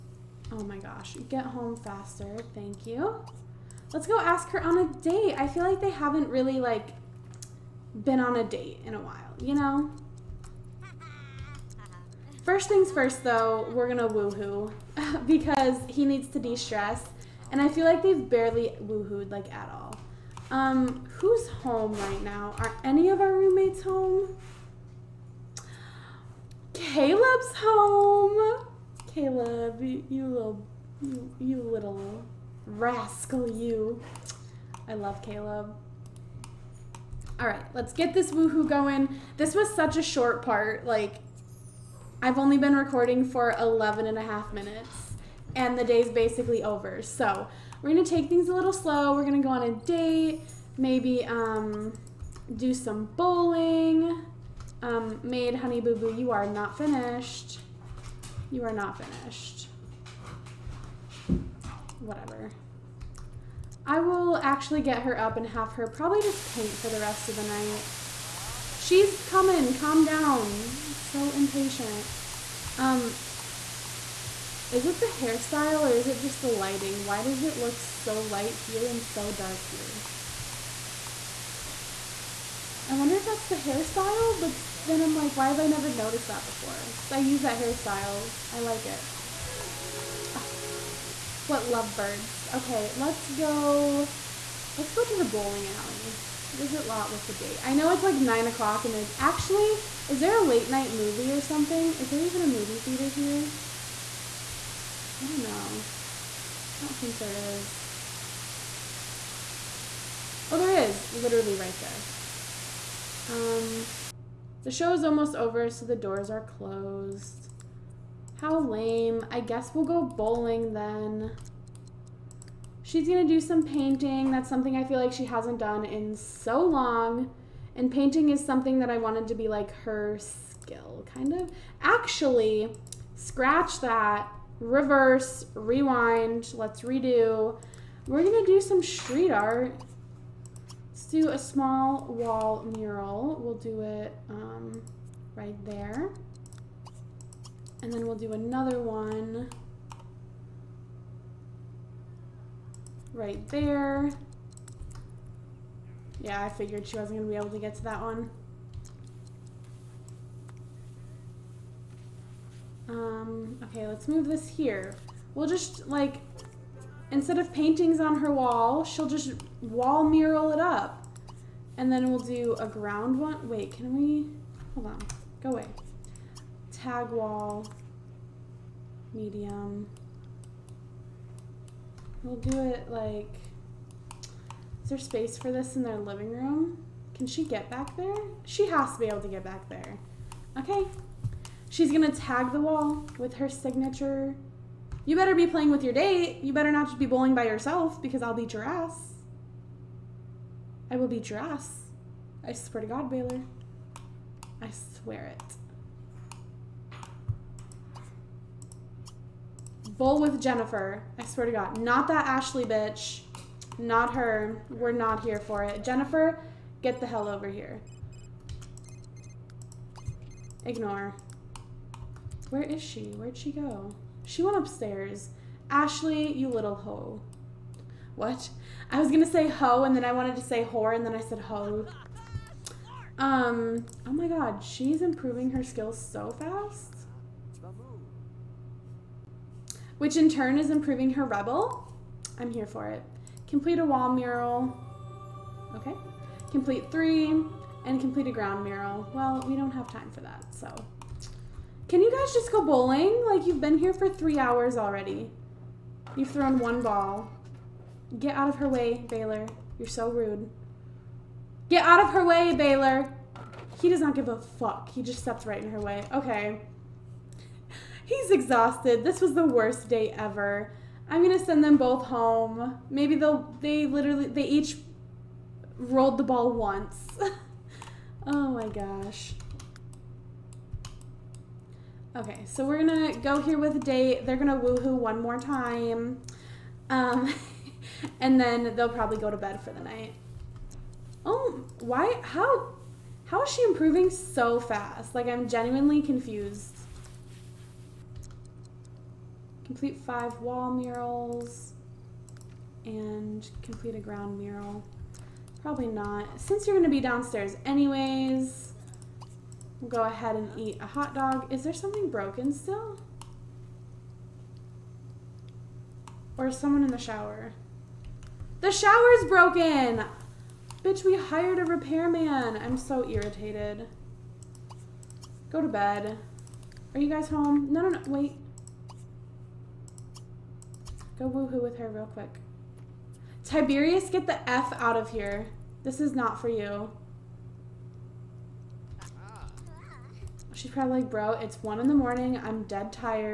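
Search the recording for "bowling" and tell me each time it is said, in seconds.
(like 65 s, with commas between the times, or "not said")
53 s, 95 s, 120 s, 197 s, 252 s.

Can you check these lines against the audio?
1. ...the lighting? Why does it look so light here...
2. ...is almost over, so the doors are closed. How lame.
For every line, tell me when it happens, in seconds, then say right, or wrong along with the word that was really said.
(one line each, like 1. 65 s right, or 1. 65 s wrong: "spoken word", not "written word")
1. 76 s right
2. 114 s right.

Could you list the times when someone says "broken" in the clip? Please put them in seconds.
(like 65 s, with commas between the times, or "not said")
312 s, 319 s.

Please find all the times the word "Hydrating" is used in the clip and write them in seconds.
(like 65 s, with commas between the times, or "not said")
not said.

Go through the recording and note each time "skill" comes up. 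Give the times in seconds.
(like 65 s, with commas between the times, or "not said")
130 s, 235 s.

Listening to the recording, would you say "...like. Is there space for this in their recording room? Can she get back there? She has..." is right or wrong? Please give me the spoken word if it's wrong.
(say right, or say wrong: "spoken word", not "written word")
wrong: "living", not "recording".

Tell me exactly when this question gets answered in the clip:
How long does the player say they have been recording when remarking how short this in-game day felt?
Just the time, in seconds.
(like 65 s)
43 s.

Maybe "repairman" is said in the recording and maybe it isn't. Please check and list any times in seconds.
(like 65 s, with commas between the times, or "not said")
321 s.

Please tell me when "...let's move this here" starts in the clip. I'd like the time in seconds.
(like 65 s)
163 s.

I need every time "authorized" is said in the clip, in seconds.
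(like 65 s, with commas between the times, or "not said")
not said.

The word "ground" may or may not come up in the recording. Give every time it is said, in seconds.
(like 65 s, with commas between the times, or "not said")
172 s, 248 s, 303 s.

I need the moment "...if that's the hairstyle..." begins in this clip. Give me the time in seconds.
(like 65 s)
83 s.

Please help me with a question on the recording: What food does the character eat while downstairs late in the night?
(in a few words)
A hot dog.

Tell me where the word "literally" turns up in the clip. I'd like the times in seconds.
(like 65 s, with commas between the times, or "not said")
111 s, 273 s.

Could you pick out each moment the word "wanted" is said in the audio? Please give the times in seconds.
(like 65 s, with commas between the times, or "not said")
128 s, 230 s.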